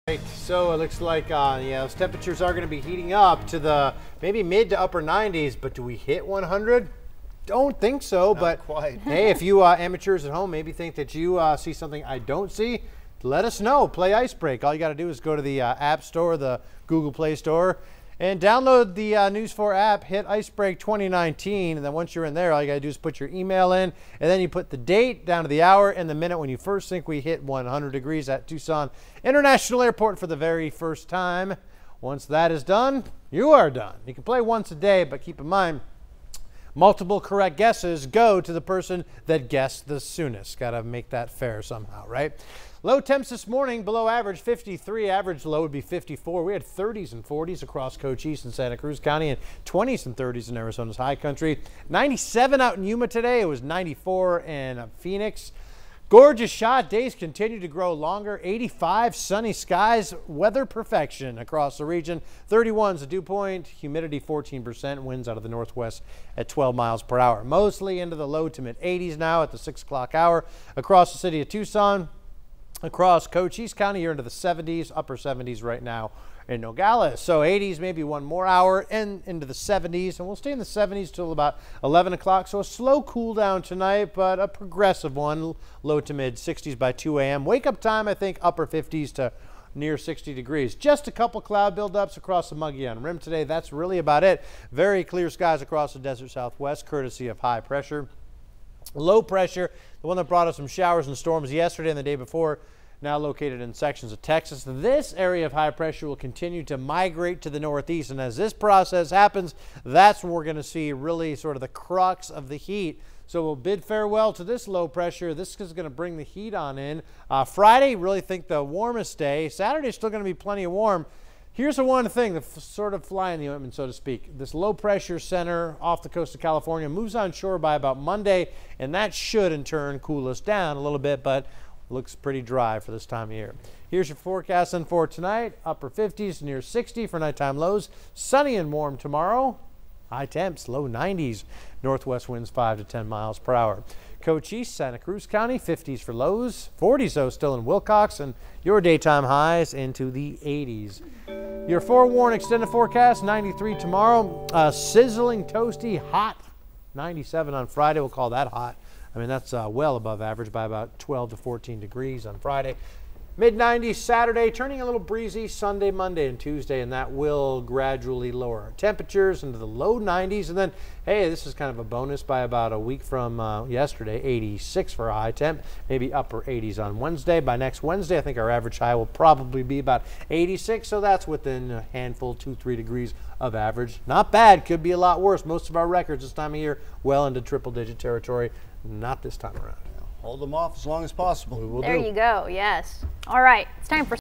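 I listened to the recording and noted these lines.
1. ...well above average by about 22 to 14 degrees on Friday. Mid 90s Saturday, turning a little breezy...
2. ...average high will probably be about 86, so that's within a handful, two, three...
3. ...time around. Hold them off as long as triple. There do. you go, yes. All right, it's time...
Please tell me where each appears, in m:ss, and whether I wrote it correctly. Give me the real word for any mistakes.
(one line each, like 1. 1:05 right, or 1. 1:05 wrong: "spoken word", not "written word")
1. 2:39 wrong: "12", not "22"
2. 2:58 right
3. 3:09 wrong: "possible", not "triple".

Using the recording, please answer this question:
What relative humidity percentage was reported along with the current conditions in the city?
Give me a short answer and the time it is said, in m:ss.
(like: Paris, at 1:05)
14%, at 1:03.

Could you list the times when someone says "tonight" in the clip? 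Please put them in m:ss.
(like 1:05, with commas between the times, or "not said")
1:23, 2:15.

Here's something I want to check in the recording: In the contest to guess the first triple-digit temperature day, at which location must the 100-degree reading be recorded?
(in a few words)
Tucson International Airport.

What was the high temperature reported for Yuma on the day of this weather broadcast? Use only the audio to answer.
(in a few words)
97.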